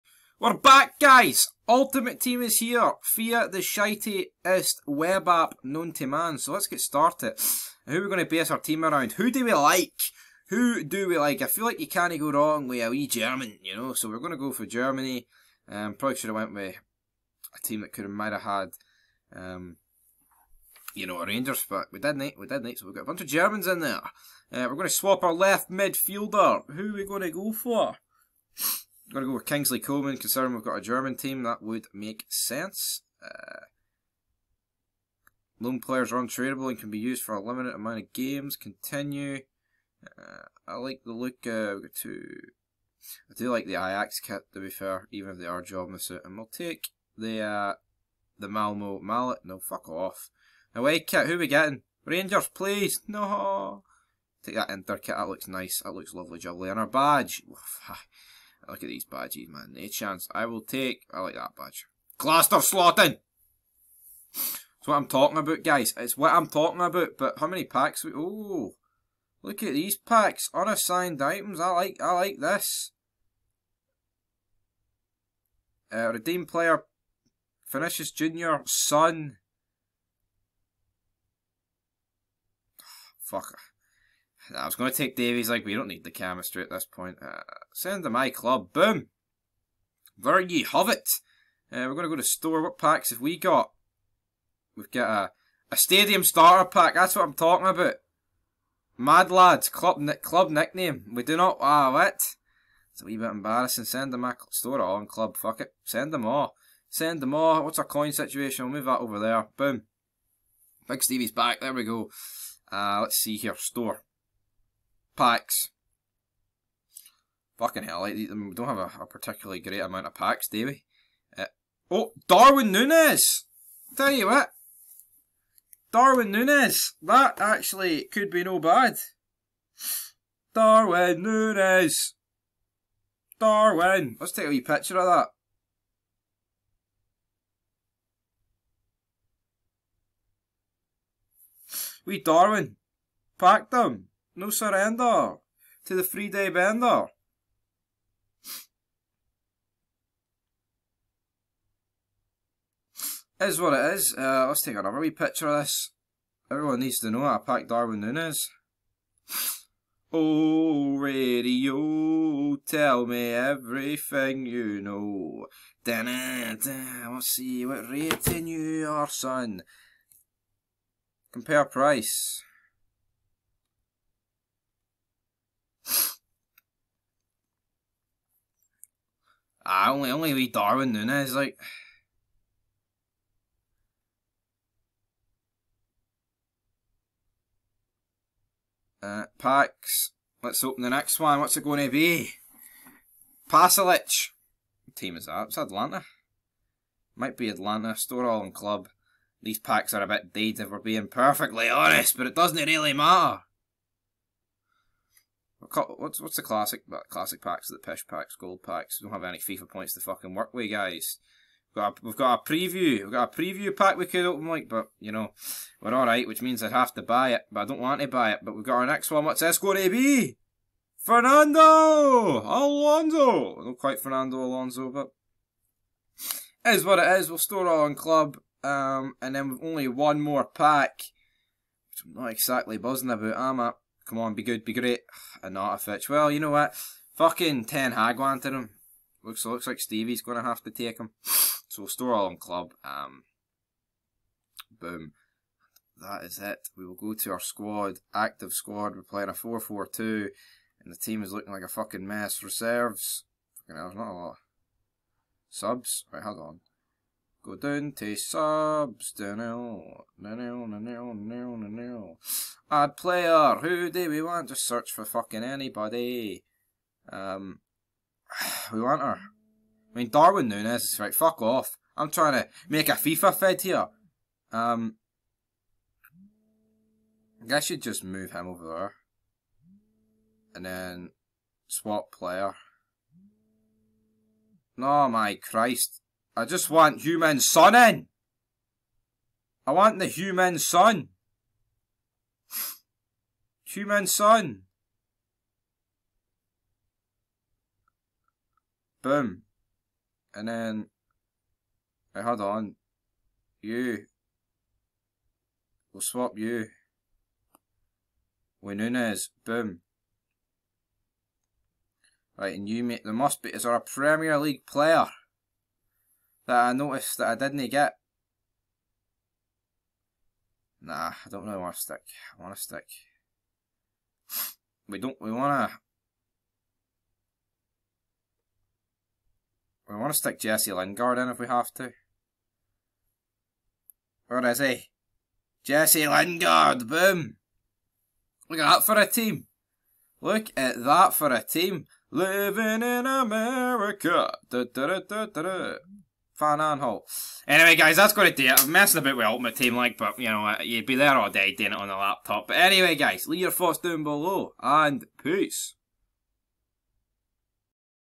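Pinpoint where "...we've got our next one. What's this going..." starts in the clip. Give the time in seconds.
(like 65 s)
218 s.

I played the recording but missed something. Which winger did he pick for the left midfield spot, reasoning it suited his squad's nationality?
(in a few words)
Kingsley Coman.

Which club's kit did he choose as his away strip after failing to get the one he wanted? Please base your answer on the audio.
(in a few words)
Inter.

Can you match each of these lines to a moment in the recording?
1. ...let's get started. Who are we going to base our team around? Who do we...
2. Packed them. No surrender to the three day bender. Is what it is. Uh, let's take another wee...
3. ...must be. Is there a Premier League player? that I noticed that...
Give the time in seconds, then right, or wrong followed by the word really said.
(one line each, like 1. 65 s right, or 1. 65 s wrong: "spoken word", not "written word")
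1. 6 s right
2. 143 s right
3. 313 s right.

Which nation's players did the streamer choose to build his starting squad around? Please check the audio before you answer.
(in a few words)
Germany.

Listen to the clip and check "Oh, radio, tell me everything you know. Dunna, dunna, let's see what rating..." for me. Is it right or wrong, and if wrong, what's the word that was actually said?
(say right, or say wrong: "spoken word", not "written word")
right.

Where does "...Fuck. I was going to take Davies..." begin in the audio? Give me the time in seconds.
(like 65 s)
83 s.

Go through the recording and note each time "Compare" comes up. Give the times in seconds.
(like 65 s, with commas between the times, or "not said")
171 s.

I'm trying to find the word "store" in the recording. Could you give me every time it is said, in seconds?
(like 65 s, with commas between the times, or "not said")
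92 s, 104 s, 113 s, 197 s, 227 s, 241 s.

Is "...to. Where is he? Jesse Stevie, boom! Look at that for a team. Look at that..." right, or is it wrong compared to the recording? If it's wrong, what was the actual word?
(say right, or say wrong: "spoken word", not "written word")
wrong: "Lingard", not "Stevie".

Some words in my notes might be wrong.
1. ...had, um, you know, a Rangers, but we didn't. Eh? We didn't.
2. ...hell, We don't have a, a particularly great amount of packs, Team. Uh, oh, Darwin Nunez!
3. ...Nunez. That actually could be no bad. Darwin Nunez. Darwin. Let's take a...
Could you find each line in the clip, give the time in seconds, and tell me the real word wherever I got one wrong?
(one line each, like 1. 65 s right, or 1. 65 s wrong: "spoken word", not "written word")
1. 18 s right
2. 117 s wrong: "Davey", not "Team"
3. 126 s right.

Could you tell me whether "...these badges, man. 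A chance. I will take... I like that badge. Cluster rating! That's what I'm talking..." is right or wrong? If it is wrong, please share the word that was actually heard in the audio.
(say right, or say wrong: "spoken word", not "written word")
wrong: "slotting", not "rating".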